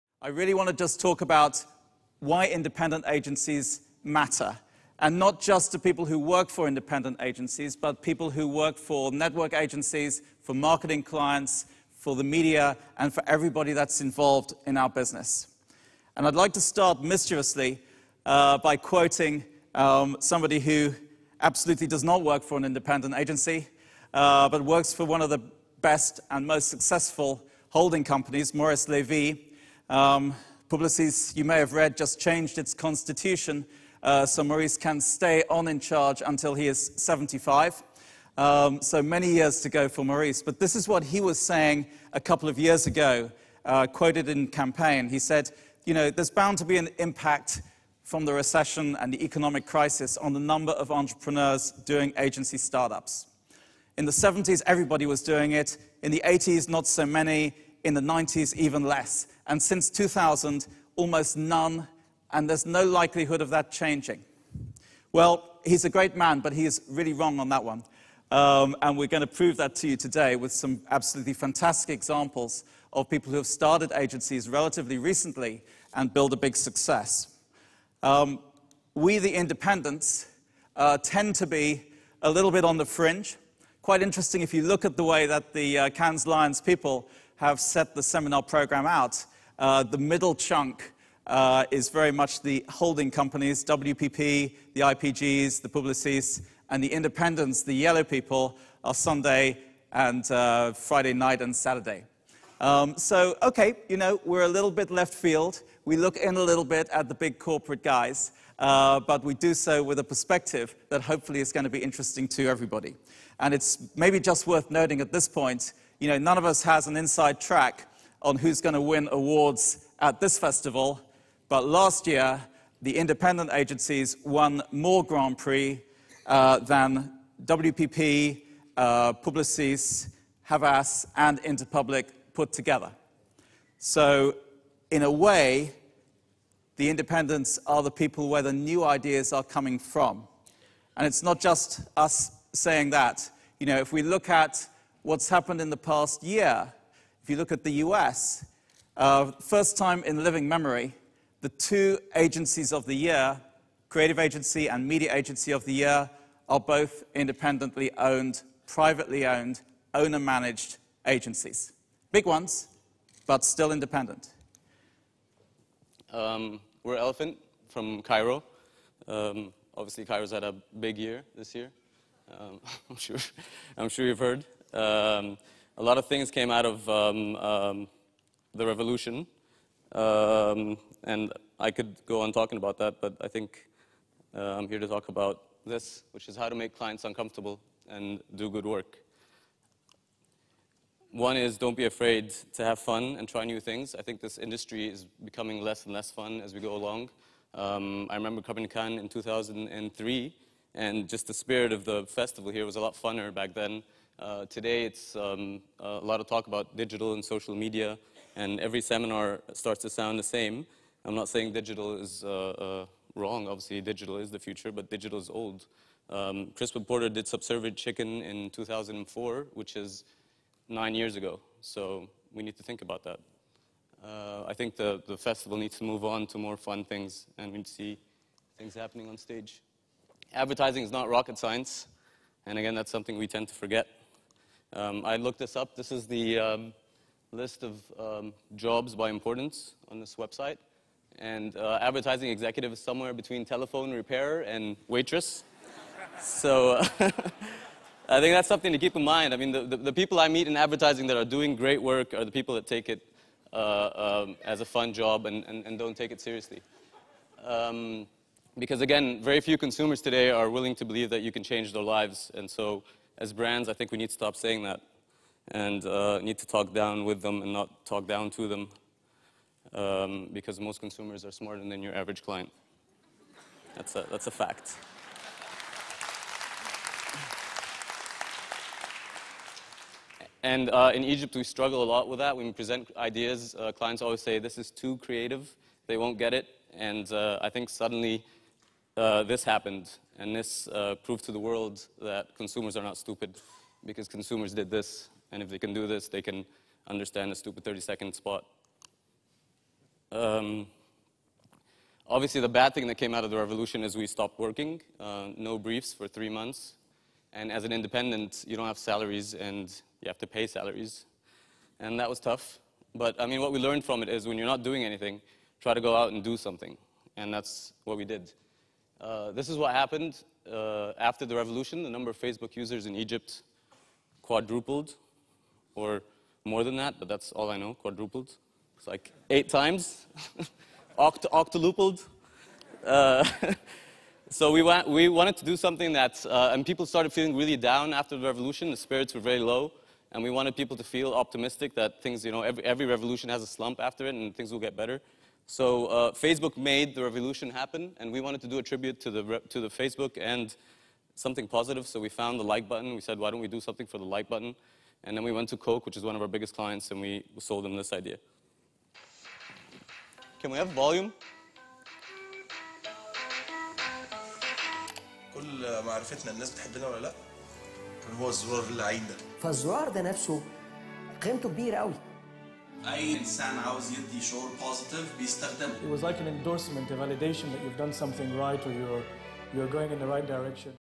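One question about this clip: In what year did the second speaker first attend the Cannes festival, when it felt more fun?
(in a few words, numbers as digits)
2003.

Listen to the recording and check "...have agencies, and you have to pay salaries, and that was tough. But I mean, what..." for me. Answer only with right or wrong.
wrong.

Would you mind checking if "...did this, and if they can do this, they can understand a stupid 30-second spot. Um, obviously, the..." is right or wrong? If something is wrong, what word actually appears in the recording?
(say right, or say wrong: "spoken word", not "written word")
right.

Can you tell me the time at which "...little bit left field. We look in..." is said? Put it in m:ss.
1:44.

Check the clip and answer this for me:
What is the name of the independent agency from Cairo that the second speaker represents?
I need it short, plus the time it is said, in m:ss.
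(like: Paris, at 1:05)
Elephant, at 2:46.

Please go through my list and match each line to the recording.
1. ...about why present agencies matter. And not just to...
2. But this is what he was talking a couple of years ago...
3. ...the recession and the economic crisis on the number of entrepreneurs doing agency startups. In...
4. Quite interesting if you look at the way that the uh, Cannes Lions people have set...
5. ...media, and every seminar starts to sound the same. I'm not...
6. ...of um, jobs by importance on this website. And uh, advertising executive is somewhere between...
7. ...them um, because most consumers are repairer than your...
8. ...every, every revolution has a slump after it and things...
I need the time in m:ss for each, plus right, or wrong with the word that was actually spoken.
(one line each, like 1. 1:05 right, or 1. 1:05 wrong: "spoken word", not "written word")
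1. 0:01 wrong: "independent", not "present"
2. 0:40 wrong: "saying", not "talking"
3. 0:48 right
4. 1:23 right
5. 3:27 right
6. 3:57 right
7. 4:28 wrong: "smarter", not "repairer"
8. 5:42 right.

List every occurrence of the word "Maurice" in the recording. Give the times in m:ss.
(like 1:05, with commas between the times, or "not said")
0:28, 0:34, 0:40.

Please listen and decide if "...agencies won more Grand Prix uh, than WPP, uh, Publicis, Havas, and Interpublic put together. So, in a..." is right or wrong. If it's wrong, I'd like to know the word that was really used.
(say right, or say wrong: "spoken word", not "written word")
right.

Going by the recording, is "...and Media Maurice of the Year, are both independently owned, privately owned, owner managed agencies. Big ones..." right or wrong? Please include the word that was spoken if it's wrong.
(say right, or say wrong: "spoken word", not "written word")
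wrong: "Agency", not "Maurice".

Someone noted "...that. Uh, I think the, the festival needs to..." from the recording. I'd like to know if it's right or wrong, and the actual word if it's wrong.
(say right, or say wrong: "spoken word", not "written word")
right.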